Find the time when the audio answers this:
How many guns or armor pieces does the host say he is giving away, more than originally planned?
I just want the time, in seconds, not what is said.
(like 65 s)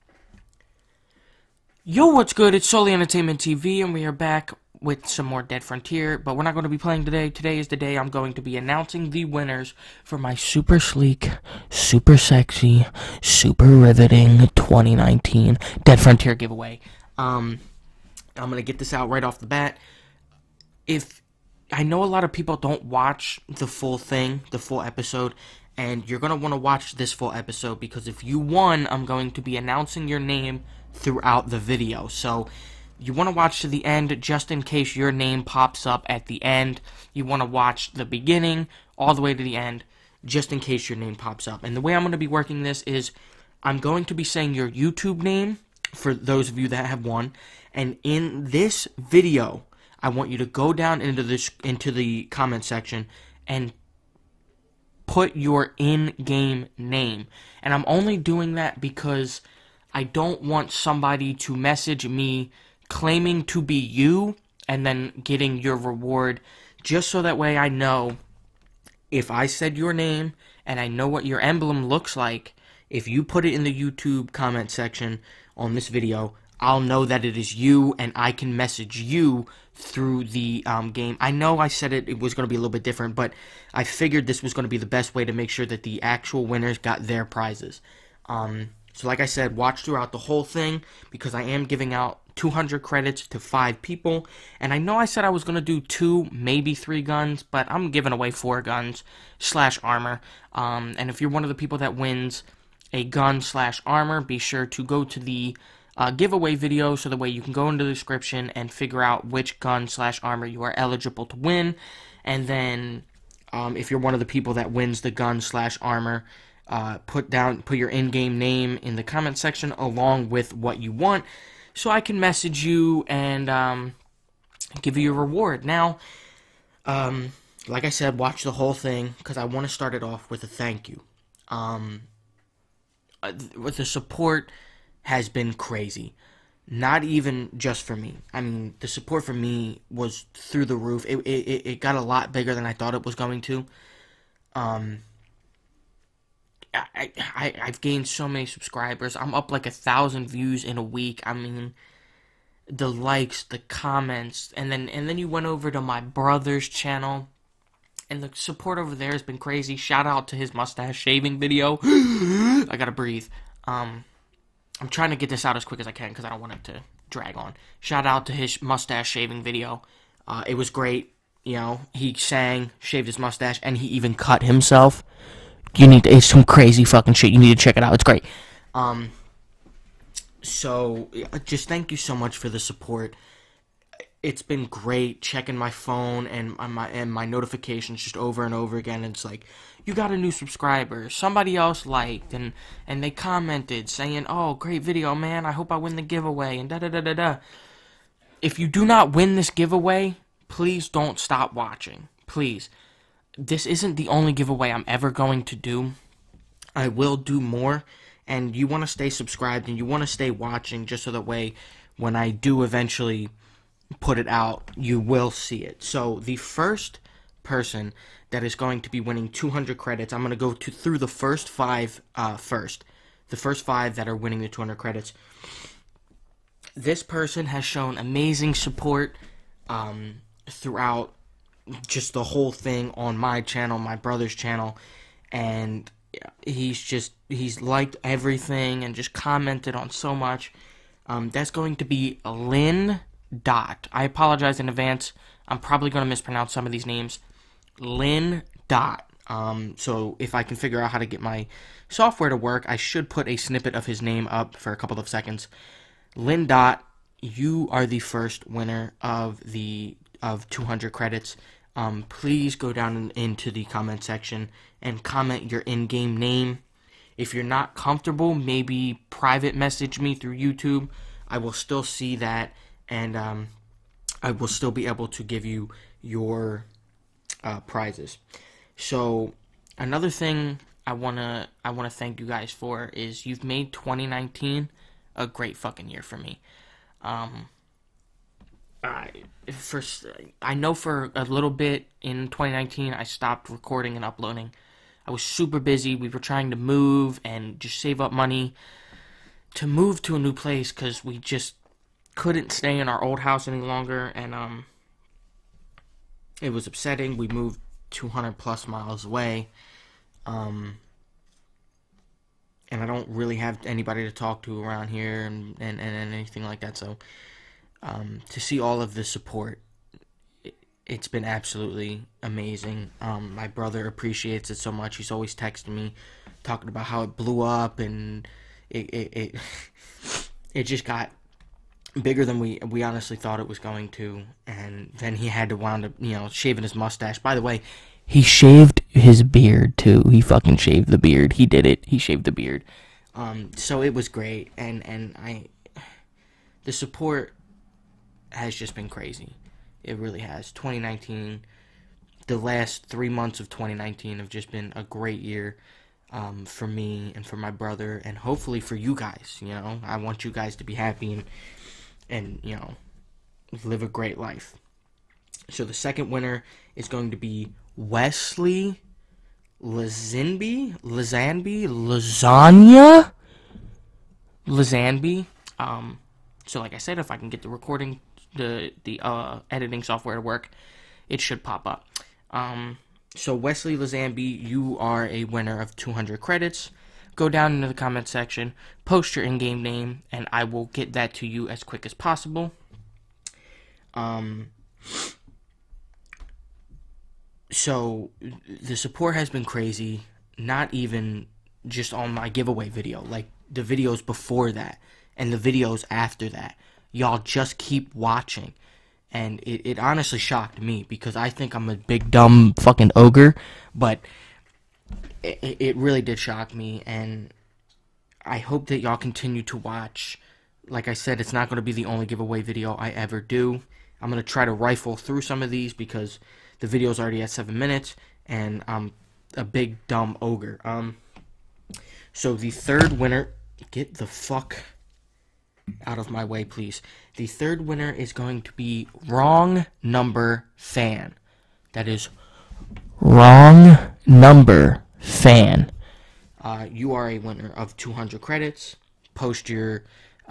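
98 s.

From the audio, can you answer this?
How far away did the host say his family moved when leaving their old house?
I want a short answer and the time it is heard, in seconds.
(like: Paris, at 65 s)
200 plus miles, at 307 s.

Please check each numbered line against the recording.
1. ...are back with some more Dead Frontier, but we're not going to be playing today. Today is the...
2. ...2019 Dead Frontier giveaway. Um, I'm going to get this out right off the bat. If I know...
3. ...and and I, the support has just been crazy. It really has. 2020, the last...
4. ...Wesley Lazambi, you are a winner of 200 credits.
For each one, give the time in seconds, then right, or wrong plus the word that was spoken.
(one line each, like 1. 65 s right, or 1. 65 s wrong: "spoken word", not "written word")
1. 4 s right
2. 14 s right
3. 344 s wrong: "2019", not "2020"
4. 383 s right.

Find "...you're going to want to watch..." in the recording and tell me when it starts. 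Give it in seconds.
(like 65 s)
26 s.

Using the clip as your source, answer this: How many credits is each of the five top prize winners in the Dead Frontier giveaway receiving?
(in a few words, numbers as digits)
200.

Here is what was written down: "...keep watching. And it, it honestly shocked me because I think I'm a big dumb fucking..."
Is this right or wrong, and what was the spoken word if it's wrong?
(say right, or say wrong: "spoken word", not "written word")
right.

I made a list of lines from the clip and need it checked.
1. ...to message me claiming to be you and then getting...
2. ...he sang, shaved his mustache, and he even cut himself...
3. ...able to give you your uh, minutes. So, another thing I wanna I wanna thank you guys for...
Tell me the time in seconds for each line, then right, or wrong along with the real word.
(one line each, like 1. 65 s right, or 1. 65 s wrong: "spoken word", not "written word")
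1. 61 s right
2. 171 s right
3. 274 s wrong: "prizes", not "minutes".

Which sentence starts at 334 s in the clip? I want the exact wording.
And then he had to wound up, you know, shaving his mustache.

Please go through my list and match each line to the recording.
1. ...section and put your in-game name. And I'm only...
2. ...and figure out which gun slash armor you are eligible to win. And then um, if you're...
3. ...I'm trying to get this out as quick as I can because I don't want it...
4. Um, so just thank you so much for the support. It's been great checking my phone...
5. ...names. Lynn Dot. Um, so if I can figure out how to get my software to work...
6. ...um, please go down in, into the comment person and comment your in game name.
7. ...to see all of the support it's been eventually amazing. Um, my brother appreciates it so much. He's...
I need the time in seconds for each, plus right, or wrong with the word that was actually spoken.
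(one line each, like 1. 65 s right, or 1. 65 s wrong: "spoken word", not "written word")
1. 52 s right
2. 108 s right
3. 164 s right
4. 178 s right
5. 246 s right
6. 261 s wrong: "section", not "person"
7. 318 s wrong: "absolutely", not "eventually".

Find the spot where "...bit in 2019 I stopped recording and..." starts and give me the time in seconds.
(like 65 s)
291 s.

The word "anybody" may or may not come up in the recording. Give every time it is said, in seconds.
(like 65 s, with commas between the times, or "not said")
313 s.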